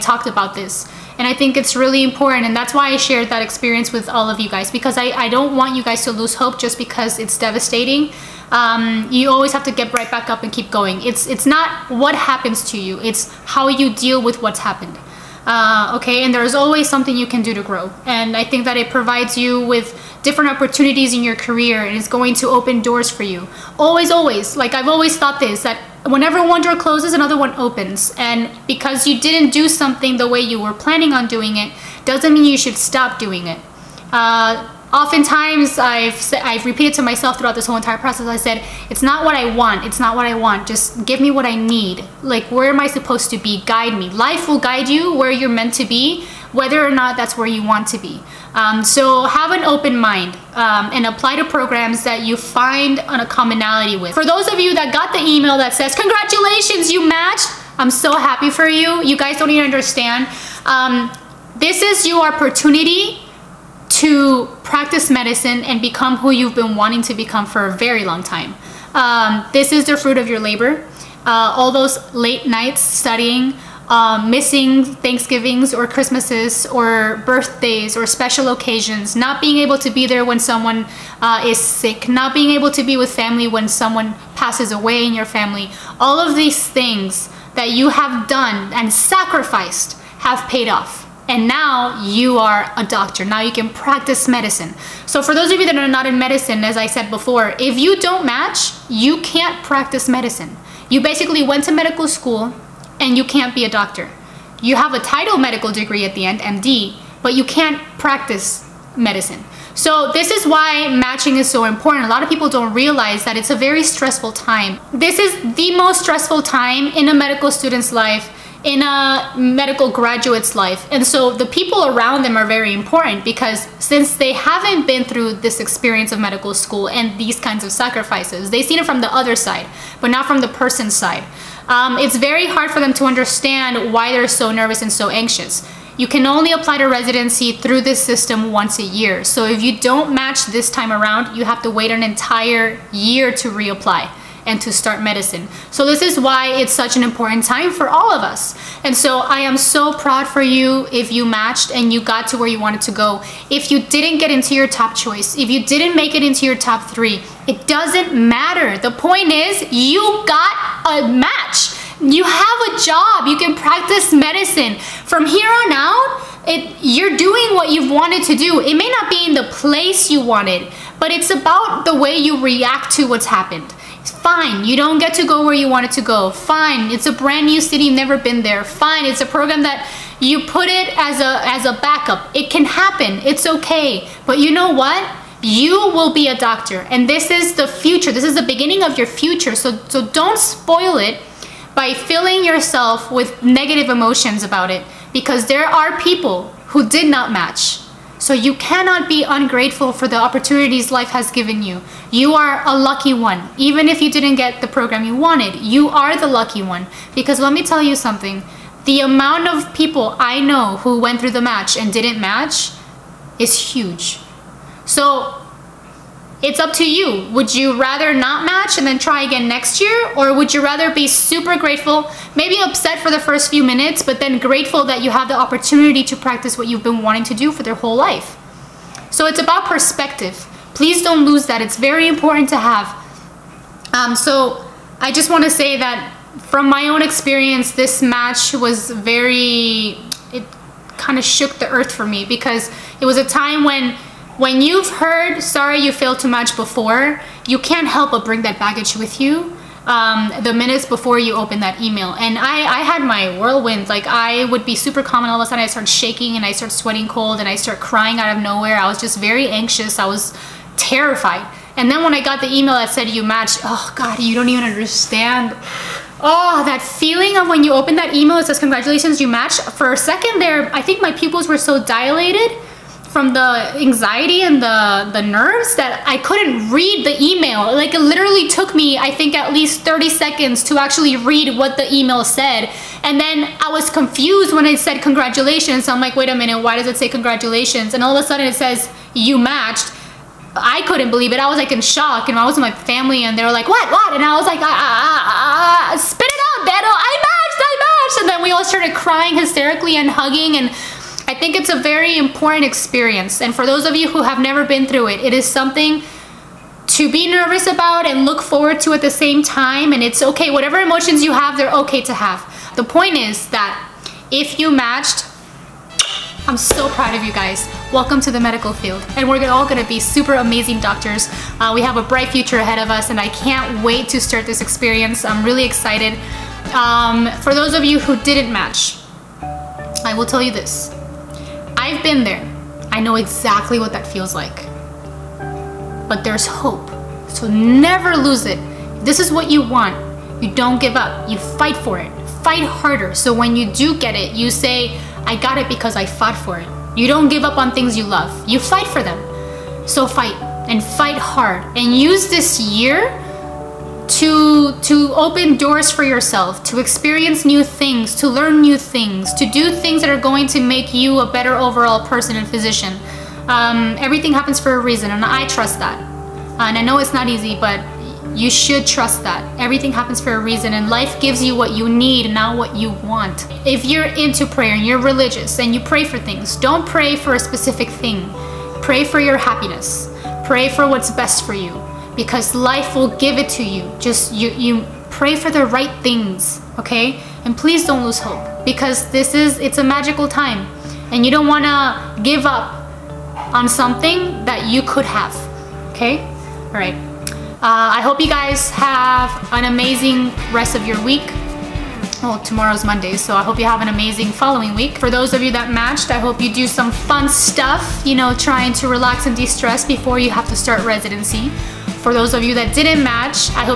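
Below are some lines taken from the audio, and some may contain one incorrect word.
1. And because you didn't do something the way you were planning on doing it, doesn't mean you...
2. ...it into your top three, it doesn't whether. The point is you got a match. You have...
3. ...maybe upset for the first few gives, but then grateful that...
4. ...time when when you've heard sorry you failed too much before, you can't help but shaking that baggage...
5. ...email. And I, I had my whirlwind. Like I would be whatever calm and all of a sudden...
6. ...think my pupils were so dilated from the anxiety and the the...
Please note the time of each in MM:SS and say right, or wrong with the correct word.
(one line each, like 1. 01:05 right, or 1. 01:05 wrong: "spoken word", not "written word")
1. 00:28 right
2. 02:36 wrong: "matter", not "whether"
3. 03:42 wrong: "minutes", not "gives"
4. 04:03 wrong: "bring", not "shaking"
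5. 04:11 wrong: "super", not "whatever"
6. 04:30 right.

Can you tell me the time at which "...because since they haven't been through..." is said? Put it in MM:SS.
02:03.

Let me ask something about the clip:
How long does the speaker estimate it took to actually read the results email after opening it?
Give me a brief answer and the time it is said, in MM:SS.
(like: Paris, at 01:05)
30 seconds, at 04:39.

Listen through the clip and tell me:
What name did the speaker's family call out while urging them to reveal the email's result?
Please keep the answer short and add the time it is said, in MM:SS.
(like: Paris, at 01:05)
Beto, at 04:56.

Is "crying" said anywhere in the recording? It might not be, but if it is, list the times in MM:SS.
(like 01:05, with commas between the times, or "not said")
04:17, 04:58.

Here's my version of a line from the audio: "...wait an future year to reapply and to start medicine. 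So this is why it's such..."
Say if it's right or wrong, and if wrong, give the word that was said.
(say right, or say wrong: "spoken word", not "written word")
wrong: "entire", not "future".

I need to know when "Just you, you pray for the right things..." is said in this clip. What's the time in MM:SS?
06:23.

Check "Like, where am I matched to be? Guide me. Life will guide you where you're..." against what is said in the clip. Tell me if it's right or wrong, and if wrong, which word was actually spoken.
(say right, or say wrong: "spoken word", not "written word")
wrong: "supposed", not "matched".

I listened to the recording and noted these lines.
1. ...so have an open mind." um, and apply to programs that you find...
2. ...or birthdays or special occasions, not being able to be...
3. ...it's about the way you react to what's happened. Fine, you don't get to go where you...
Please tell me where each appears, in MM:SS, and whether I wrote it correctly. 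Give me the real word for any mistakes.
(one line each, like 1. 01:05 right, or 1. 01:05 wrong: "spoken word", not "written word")
1. 00:48 right
2. 01:16 right
3. 02:51 right.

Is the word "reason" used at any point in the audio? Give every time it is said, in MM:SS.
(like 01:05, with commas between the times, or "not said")
06:04, 06:10.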